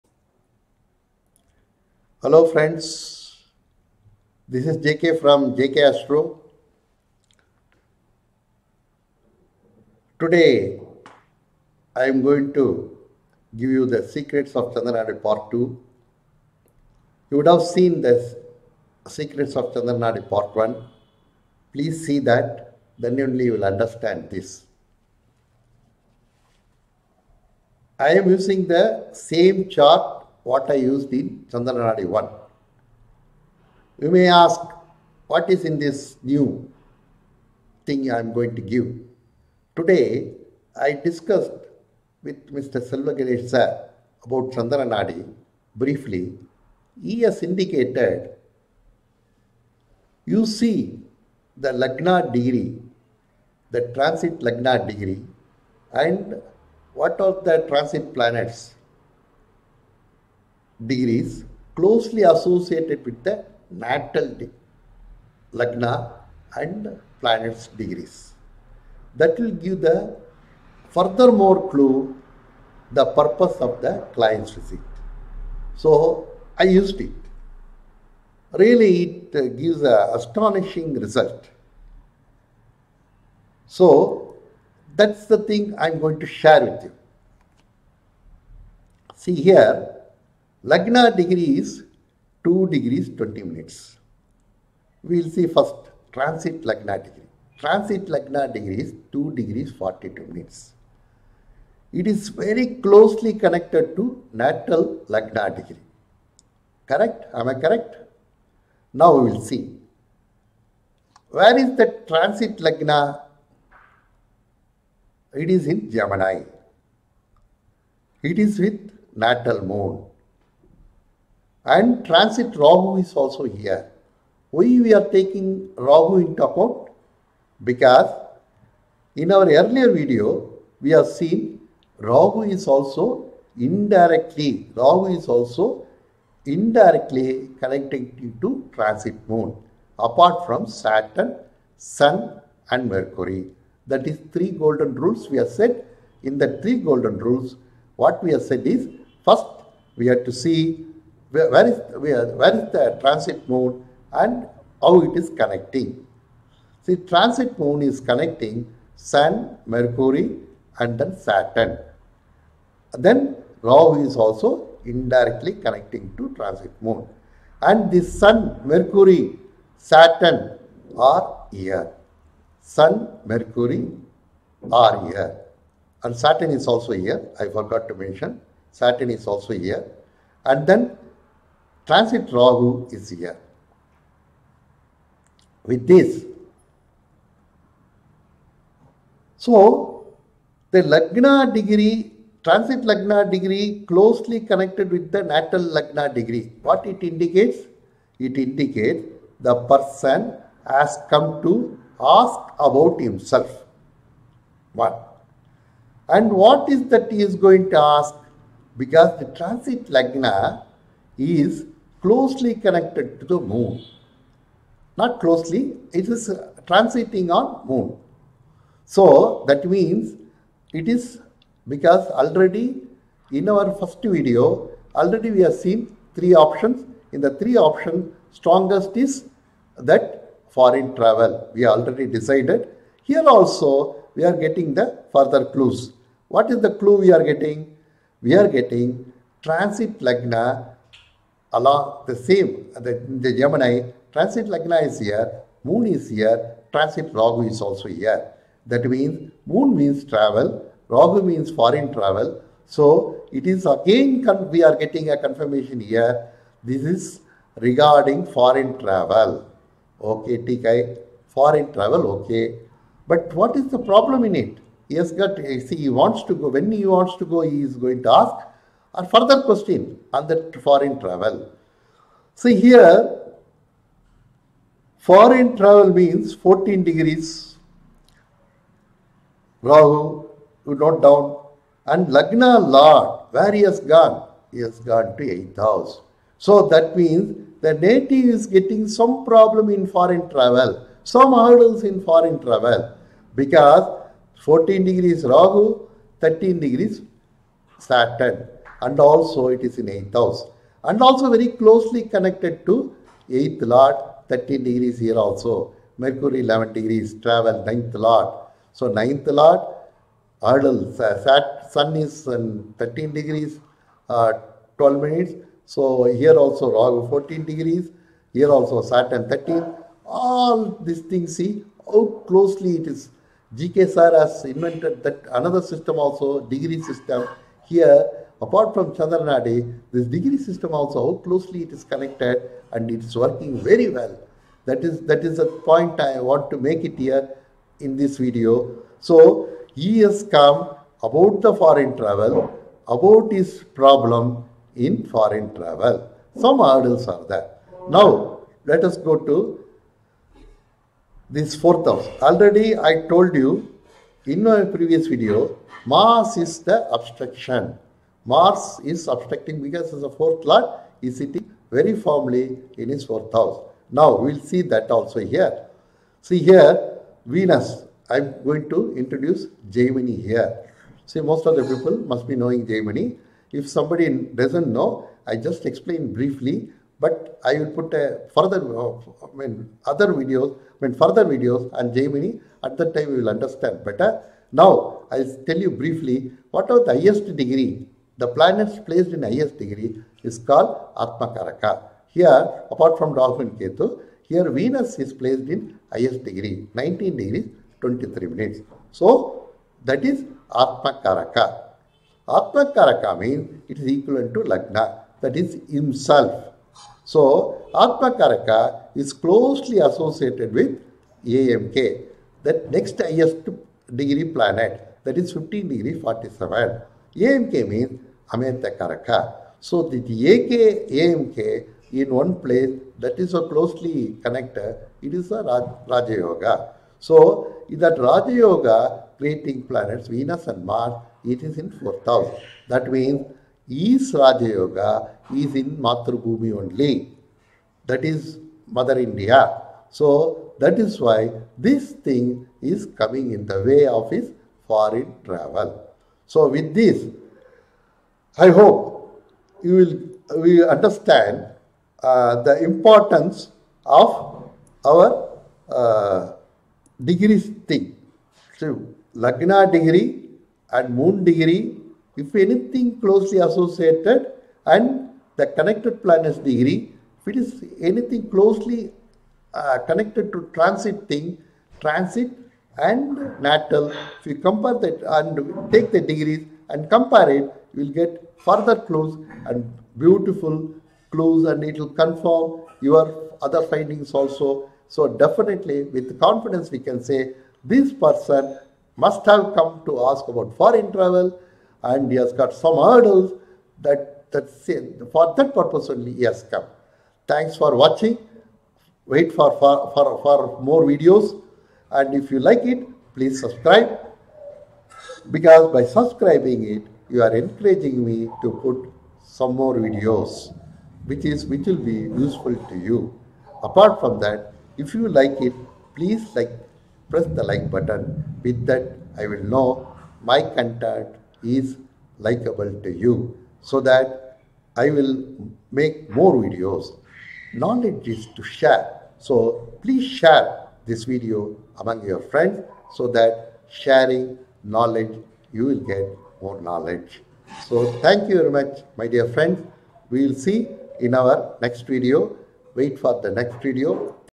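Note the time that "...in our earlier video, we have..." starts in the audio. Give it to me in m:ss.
2:09.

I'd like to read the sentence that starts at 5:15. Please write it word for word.
So here also Rahu 14 degrees, here also Saturn 13.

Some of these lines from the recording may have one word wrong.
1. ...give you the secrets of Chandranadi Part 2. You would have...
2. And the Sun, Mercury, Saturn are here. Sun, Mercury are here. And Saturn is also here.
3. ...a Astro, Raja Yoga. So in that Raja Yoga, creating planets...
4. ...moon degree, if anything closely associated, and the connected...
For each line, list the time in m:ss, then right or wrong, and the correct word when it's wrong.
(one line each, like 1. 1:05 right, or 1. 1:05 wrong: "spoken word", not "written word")
1. 0:13 right
2. 2:47 right
3. 7:05 wrong: "Raj", not "Astro"
4. 7:40 right.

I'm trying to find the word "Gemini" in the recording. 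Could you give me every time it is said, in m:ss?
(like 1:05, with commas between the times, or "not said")
1:55, 4:03.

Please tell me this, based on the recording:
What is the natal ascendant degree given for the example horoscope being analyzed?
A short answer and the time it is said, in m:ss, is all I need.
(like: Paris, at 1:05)
2 degrees 20 minutes, at 1:32.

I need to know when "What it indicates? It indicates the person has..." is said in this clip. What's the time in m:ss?
3:16.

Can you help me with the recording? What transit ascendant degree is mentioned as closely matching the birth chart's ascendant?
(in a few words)
2 degrees 42 minutes.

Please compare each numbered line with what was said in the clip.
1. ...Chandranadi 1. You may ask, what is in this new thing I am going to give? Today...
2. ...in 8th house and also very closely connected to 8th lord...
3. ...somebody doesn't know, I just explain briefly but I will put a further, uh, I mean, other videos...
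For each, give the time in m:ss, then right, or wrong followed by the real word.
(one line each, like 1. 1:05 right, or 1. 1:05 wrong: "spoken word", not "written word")
1. 0:31 right
2. 4:59 right
3. 6:13 right.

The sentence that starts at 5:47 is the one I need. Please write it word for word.
Now, let us go to this fourth house.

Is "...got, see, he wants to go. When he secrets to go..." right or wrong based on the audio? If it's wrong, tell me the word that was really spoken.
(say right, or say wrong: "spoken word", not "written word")
wrong: "wants", not "secrets".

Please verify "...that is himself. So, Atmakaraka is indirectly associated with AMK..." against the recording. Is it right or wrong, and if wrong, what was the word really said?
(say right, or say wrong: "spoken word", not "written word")
wrong: "closely", not "indirectly".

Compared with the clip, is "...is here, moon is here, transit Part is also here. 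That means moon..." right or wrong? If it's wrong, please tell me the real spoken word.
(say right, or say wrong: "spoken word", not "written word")
wrong: "Rahu", not "Part".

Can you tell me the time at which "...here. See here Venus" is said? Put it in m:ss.
6:05.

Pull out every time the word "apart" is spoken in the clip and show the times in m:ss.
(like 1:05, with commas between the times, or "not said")
2:19, 5:28, 6:32, 8:33.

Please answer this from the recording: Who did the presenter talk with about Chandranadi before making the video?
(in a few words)
Selvagirish.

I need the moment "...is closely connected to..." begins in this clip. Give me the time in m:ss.
3:31.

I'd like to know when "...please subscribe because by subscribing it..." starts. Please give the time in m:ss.
8:23.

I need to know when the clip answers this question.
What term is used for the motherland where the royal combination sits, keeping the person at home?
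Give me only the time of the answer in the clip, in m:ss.
7:15.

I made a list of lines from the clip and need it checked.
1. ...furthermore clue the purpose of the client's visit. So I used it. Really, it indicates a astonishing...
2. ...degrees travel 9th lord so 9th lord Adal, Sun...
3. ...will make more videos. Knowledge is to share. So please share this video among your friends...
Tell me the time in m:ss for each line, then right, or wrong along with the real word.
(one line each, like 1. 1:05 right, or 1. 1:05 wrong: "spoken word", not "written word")
1. 1:10 wrong: "gives", not "indicates"
2. 5:06 right
3. 8:44 right.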